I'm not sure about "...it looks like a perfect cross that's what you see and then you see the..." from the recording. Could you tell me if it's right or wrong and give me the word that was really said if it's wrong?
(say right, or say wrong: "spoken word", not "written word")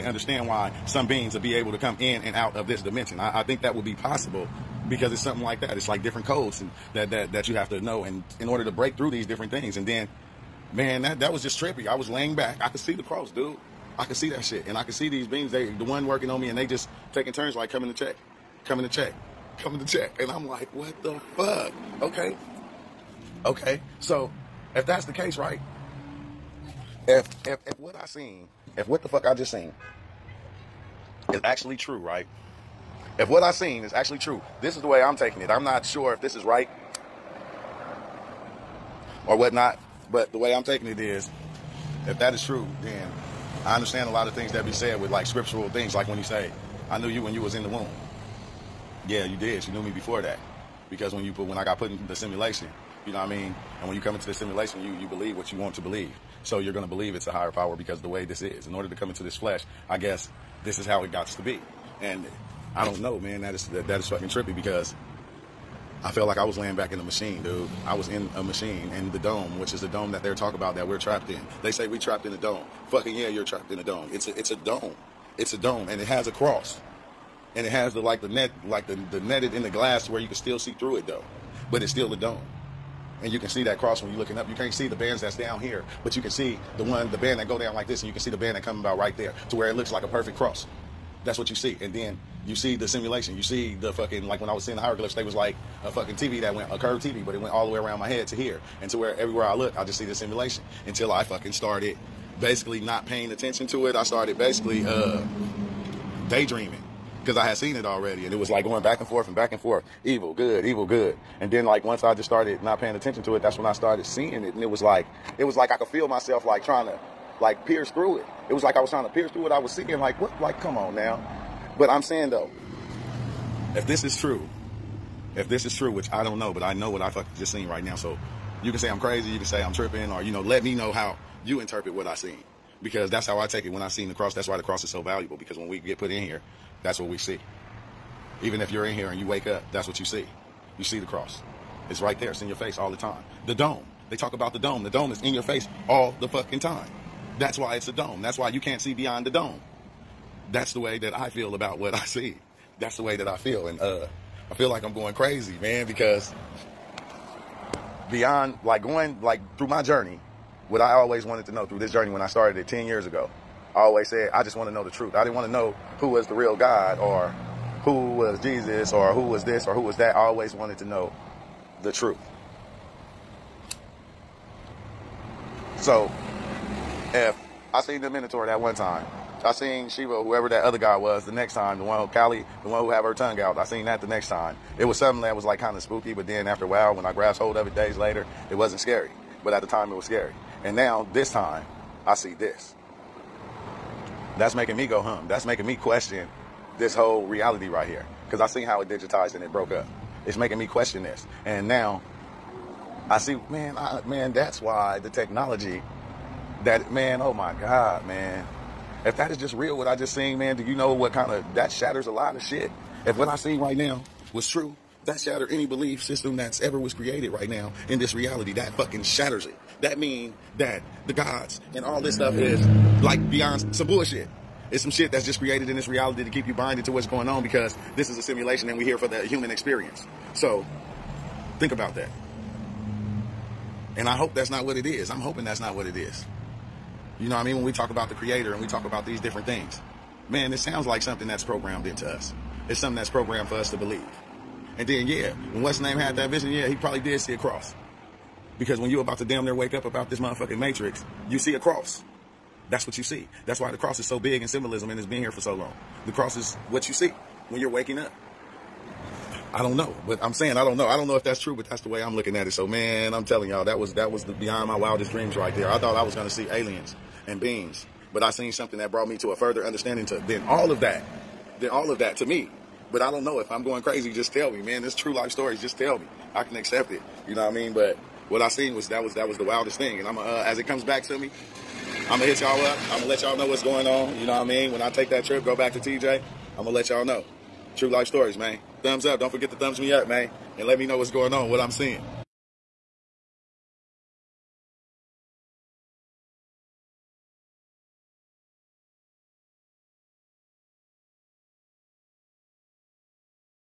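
right.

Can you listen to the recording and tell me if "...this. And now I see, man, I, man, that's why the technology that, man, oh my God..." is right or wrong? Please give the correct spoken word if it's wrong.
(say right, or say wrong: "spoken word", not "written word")
right.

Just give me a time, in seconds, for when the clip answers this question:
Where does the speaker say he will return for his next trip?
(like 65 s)
285 s.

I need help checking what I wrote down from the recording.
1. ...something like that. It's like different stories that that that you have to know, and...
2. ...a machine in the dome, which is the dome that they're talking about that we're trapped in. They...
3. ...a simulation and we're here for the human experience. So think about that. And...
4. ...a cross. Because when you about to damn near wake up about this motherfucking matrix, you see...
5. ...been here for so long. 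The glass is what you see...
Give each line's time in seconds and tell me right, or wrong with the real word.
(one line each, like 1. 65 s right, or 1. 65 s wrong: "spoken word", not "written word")
1. 5 s wrong: "codes", not "stories"
2. 68 s right
3. 228 s right
4. 247 s right
5. 255 s wrong: "cross", not "glass".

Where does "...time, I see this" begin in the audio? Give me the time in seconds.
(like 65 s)
191 s.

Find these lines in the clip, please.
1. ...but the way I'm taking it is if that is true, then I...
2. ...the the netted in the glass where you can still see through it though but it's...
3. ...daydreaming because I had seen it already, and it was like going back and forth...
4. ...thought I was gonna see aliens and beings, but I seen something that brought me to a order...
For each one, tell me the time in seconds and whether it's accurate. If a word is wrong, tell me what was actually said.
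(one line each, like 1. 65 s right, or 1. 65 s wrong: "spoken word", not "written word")
1. 40 s right
2. 78 s right
3. 106 s right
4. 265 s wrong: "further", not "order".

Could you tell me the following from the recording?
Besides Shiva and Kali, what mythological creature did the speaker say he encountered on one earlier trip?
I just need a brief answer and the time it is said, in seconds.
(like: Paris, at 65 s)
The Minotaur, at 178 s.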